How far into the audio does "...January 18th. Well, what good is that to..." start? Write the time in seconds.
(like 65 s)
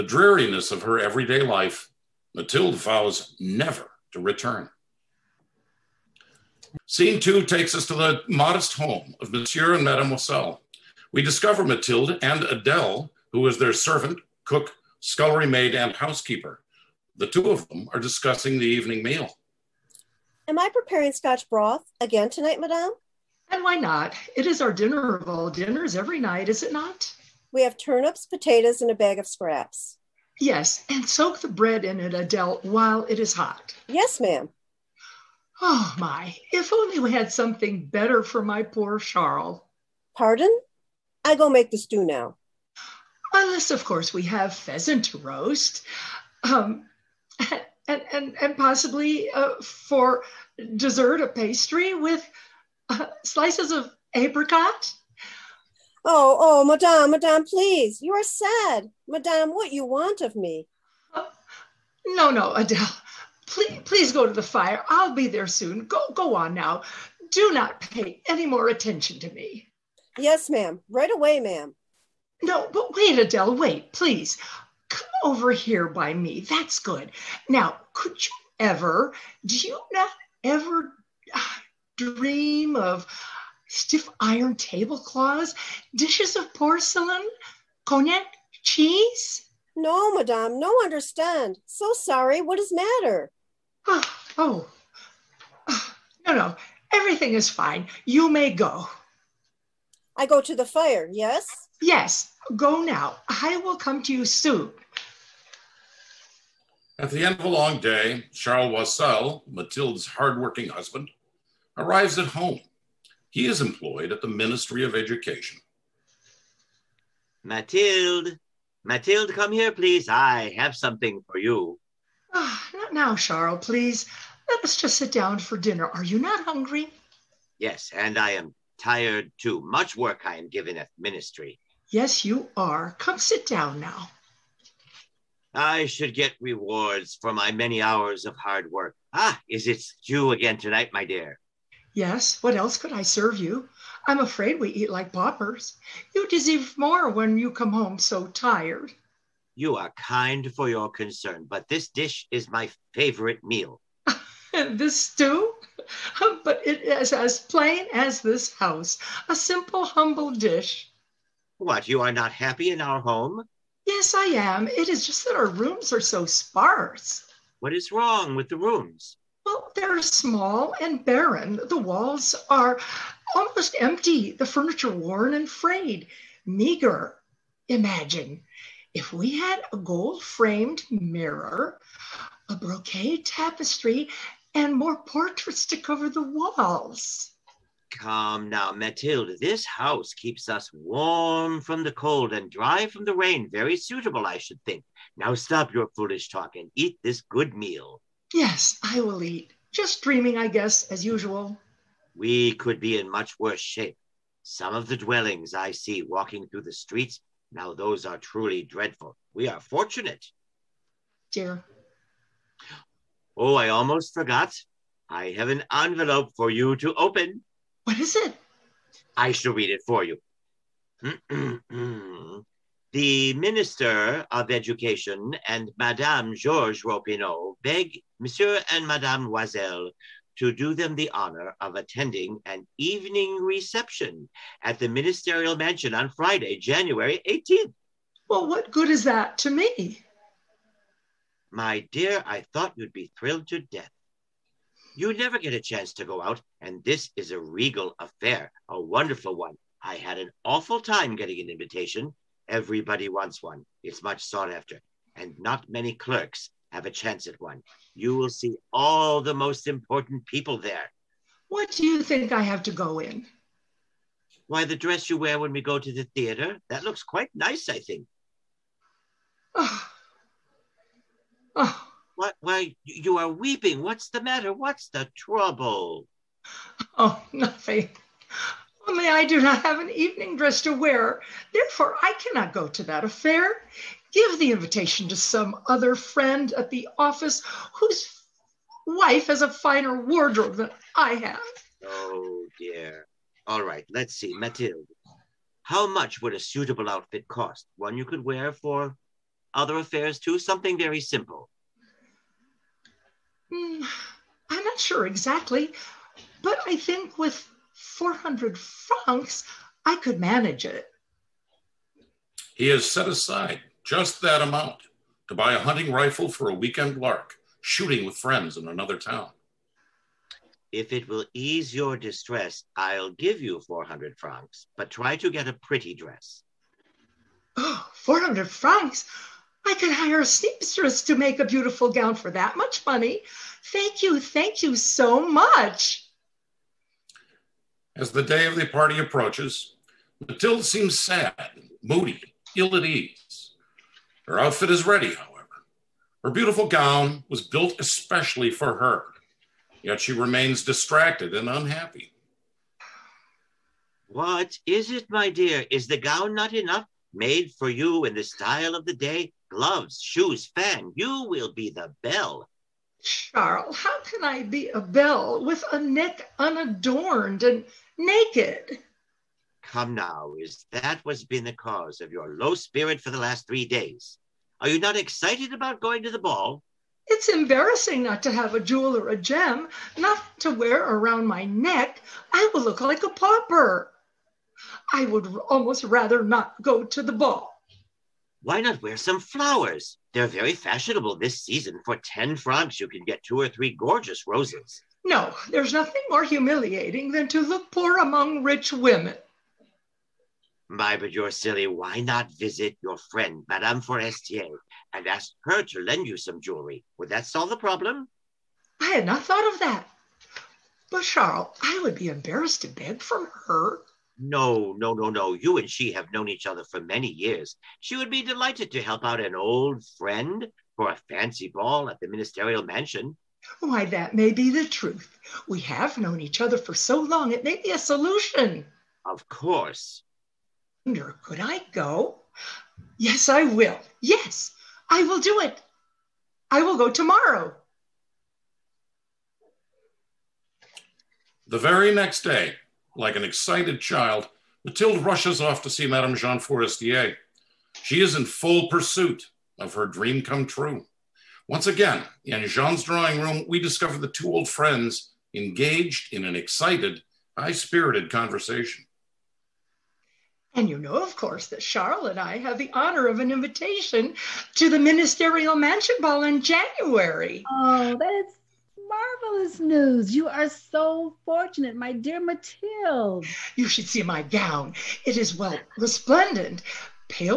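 236 s.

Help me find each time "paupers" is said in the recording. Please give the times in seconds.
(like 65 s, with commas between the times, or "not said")
145 s, 383 s.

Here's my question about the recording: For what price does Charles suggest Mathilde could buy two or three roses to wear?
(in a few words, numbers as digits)
10 francs.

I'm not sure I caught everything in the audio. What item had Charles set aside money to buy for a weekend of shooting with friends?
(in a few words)
A hunting rifle.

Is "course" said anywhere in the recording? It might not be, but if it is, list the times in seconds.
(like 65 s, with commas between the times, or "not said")
43 s, 429 s, 461 s.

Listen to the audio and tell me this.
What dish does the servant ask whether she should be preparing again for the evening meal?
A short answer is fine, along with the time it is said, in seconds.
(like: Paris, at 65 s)
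Scotch broth, at 21 s.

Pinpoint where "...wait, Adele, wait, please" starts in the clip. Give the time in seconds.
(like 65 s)
72 s.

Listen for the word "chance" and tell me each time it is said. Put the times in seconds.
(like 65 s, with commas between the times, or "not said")
245 s, 256 s.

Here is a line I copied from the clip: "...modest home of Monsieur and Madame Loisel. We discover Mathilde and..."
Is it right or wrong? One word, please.
right.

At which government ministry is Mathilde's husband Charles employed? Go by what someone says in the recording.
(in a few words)
Ministry of Education.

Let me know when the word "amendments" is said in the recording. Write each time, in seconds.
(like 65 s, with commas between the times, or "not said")
not said.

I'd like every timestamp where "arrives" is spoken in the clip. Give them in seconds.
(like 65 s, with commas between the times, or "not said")
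111 s.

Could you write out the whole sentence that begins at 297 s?
One you could wear for other affairs, too?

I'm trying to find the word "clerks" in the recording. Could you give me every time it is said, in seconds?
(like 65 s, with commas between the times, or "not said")
255 s.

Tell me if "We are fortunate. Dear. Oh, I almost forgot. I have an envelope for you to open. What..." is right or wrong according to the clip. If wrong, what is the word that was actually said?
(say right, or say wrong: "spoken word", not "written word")
right.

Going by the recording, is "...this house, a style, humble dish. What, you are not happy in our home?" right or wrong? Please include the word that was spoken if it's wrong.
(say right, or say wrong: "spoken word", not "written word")
wrong: "simple", not "style".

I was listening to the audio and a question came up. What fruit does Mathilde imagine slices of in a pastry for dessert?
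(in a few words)
Apricot.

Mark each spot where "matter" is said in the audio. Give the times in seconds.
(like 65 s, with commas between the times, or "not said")
92 s, 274 s.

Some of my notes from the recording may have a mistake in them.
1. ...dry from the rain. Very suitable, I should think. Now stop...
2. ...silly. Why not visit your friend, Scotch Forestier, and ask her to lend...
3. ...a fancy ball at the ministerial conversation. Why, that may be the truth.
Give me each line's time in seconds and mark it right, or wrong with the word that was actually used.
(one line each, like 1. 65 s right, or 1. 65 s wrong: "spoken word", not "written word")
1. 192 s right
2. 401 s wrong: "Madame", not "Scotch"
3. 420 s wrong: "mansion", not "conversation".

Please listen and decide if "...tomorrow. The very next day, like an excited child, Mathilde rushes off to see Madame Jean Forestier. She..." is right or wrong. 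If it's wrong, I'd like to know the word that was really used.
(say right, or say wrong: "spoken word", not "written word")
right.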